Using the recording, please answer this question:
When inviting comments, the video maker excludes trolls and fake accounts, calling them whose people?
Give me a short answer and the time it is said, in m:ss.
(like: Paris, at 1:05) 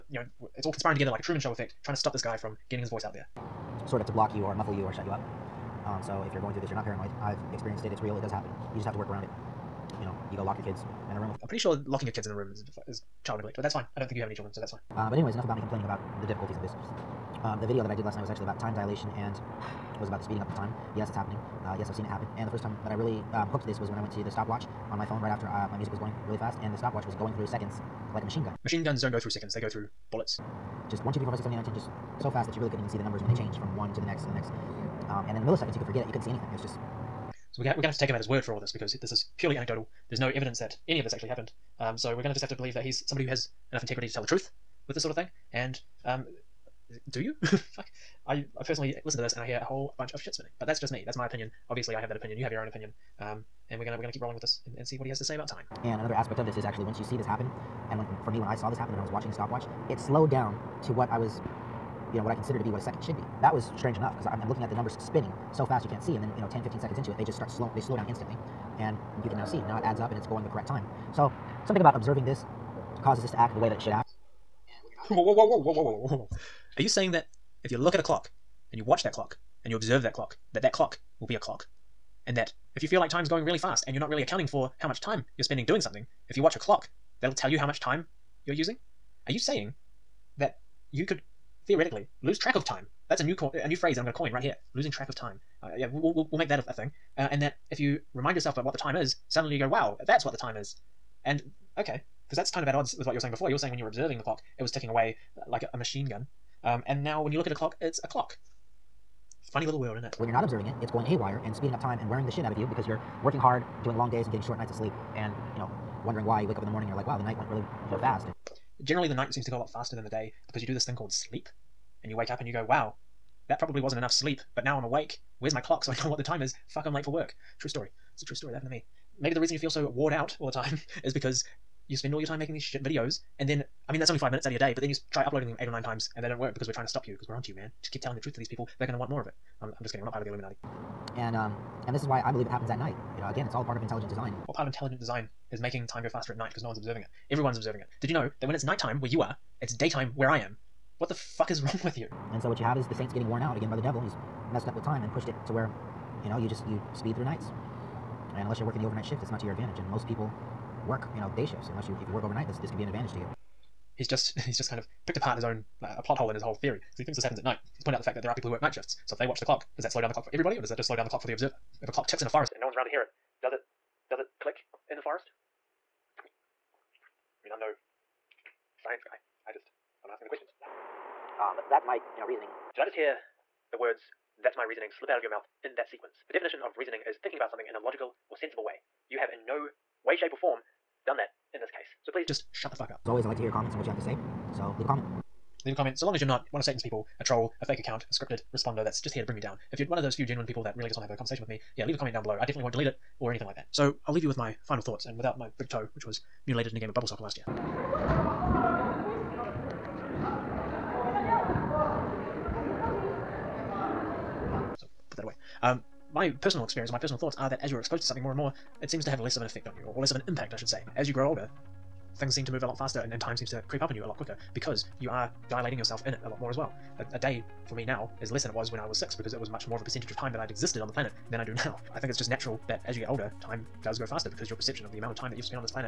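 Satan's, at 3:16.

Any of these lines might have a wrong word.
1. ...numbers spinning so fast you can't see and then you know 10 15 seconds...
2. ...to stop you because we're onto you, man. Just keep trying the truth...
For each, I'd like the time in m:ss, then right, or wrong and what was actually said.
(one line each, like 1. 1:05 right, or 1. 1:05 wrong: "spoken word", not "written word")
1. 1:04 right
2. 2:16 wrong: "telling", not "trying".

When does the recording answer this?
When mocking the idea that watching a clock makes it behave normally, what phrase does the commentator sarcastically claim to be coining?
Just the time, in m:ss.
1:34.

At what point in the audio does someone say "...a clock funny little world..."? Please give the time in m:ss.
1:48.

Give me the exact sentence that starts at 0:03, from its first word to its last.
Sort of to block you or muffle you or shut you up.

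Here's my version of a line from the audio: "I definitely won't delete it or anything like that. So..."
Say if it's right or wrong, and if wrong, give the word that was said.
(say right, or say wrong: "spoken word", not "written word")
right.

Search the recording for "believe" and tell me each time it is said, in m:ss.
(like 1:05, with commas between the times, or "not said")
0:42, 2:22.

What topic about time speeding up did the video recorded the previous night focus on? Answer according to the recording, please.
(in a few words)
Time dilation.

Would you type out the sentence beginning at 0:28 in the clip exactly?
Machine guns don't go through seconds, they go through bullets.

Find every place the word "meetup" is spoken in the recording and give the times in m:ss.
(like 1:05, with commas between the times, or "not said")
not said.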